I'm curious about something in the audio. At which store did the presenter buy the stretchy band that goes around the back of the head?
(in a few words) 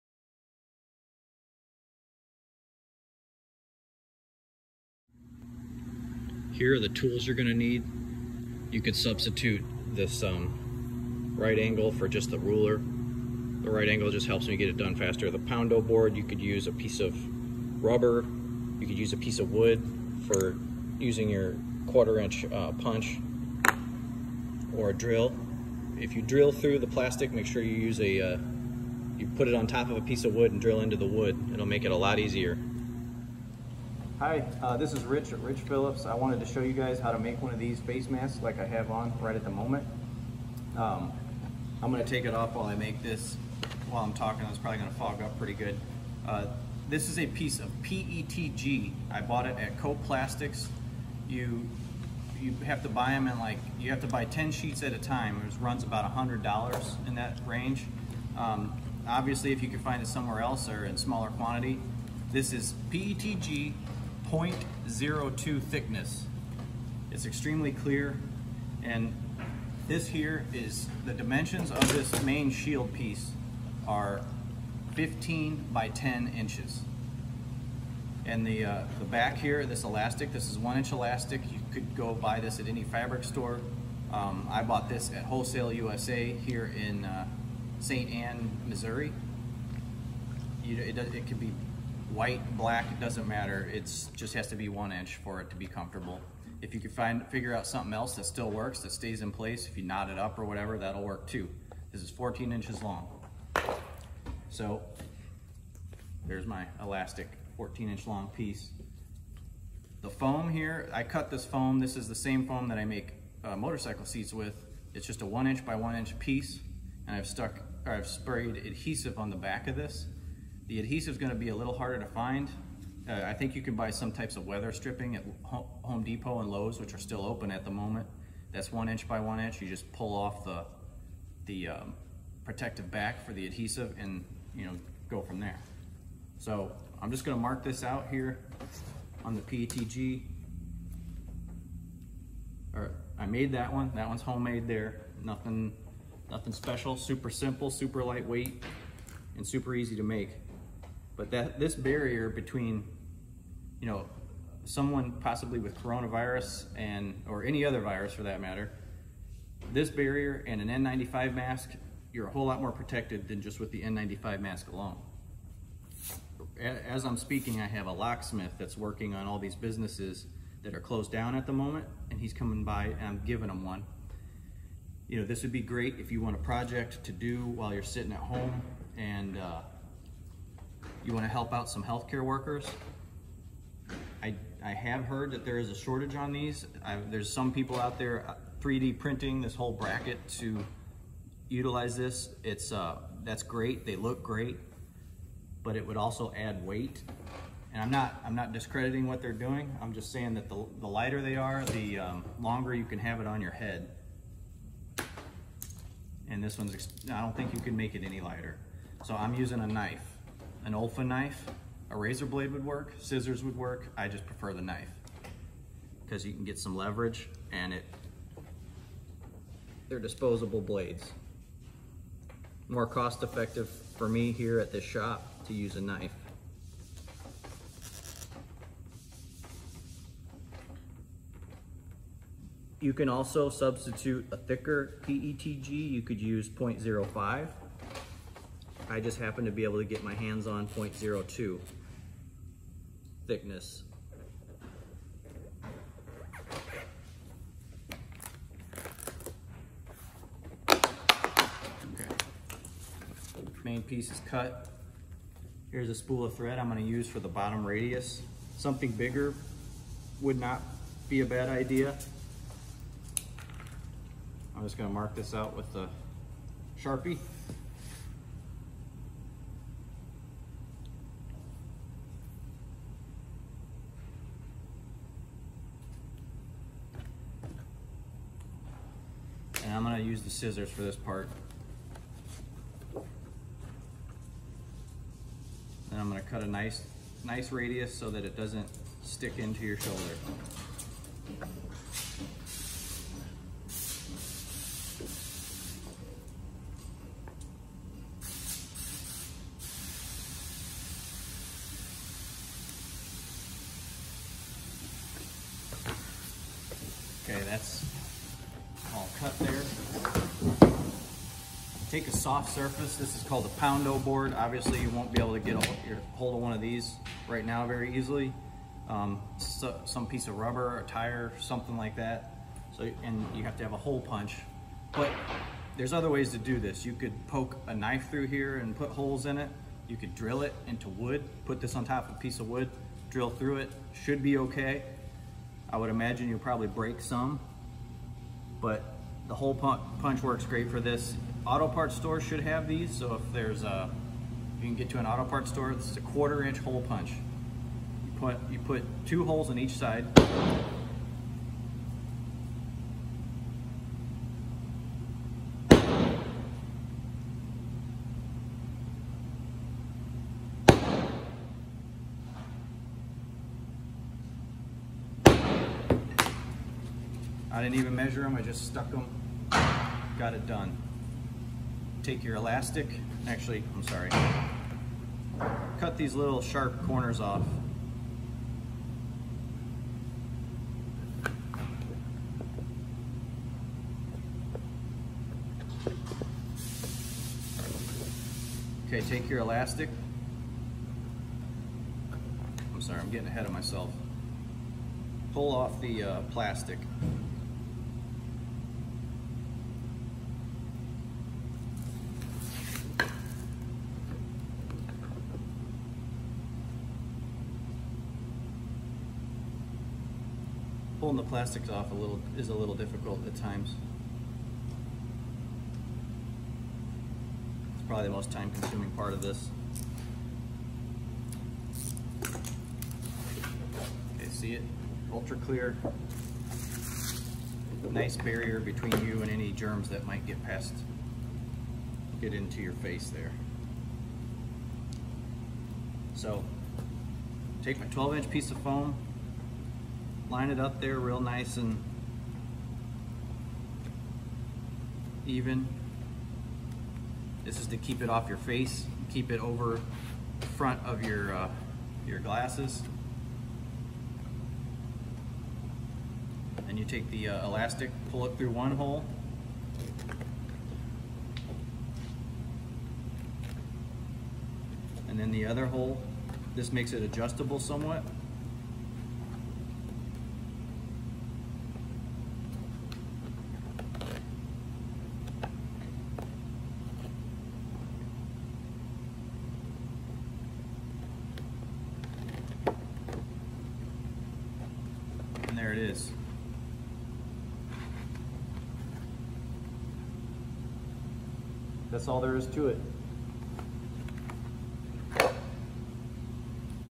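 Wholesale USA.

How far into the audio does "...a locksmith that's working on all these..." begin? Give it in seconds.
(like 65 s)
167 s.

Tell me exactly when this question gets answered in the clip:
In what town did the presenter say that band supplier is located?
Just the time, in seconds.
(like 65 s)
87 s.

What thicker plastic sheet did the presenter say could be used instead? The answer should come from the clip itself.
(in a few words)
0.05.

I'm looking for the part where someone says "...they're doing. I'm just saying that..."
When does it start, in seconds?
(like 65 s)
199 s.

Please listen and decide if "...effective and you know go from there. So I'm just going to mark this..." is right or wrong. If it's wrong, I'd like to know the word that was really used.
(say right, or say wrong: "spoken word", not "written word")
wrong: "adhesive", not "effective".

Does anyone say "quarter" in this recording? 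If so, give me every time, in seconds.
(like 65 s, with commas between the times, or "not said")
21 s, 346 s.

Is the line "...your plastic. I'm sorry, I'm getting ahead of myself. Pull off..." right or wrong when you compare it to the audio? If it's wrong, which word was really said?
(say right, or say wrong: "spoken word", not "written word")
wrong: "elastic", not "plastic".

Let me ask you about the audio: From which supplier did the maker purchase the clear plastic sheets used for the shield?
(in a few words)
Coplastics.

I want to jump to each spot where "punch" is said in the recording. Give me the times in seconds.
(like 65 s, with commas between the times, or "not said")
22 s, 323 s, 339 s, 346 s.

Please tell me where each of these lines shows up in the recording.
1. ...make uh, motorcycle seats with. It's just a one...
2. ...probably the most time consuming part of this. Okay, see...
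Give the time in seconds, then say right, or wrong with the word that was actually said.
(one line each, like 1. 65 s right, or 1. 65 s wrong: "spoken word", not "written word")
1. 112 s right
2. 417 s right.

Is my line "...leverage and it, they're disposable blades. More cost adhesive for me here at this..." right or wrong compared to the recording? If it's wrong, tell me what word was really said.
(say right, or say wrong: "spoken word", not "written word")
wrong: "effective", not "adhesive".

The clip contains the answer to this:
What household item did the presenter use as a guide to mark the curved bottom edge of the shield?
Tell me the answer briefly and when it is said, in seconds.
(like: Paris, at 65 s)
spool of thread, at 255 s.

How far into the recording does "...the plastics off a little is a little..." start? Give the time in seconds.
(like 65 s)
411 s.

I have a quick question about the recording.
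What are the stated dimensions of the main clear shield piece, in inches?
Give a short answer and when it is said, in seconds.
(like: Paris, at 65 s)
15 by 10 inches, at 74 s.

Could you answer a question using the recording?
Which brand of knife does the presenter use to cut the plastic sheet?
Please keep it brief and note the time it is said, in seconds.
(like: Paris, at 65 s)
Olfa, at 210 s.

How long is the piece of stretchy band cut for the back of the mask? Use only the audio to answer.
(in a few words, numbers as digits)
14 inches.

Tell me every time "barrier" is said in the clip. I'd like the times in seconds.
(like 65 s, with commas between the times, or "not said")
151 s, 159 s, 428 s.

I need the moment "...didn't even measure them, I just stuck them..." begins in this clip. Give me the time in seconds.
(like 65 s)
367 s.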